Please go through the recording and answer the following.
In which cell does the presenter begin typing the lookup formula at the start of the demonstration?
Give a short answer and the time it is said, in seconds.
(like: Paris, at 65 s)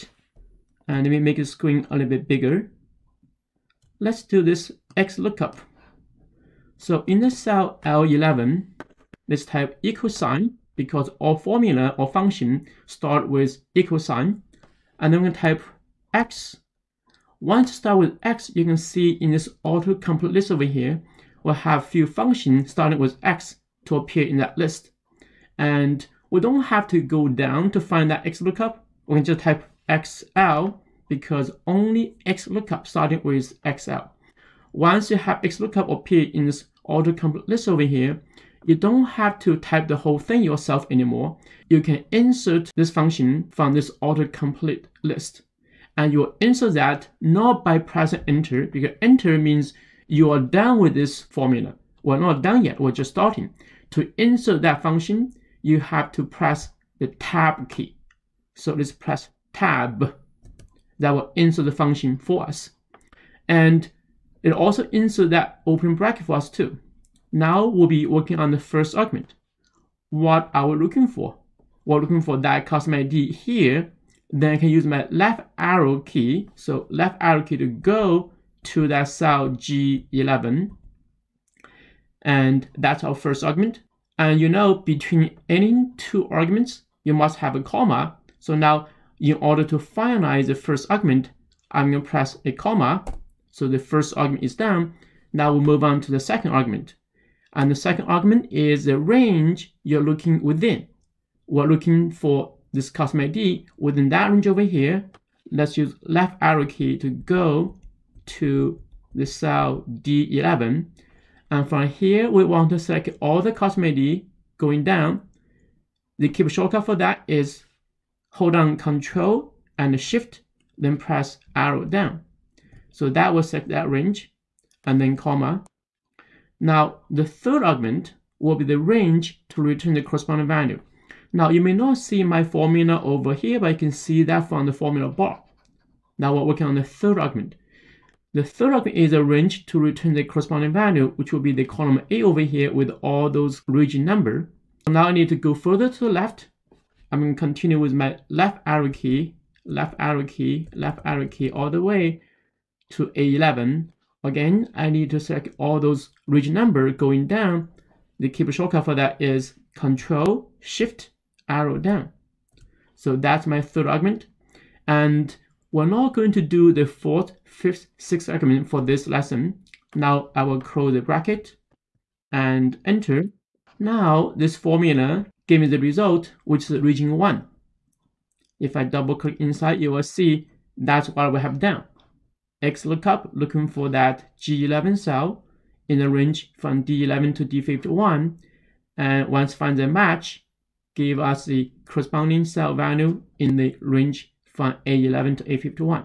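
L11, at 7 s.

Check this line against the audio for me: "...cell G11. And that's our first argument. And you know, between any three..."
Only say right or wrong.
wrong.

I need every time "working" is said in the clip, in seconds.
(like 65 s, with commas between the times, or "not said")
68 s, 136 s.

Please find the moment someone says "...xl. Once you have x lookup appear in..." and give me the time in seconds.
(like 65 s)
33 s.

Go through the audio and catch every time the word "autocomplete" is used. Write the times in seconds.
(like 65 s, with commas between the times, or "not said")
19 s, 36 s, 44 s.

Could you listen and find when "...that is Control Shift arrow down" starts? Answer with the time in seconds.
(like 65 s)
158 s.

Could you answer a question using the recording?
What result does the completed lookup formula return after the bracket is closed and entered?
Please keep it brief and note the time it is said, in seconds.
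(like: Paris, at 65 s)
Region 1, at 176 s.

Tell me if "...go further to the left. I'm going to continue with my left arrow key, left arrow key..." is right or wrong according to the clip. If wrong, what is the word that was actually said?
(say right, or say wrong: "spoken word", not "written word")
right.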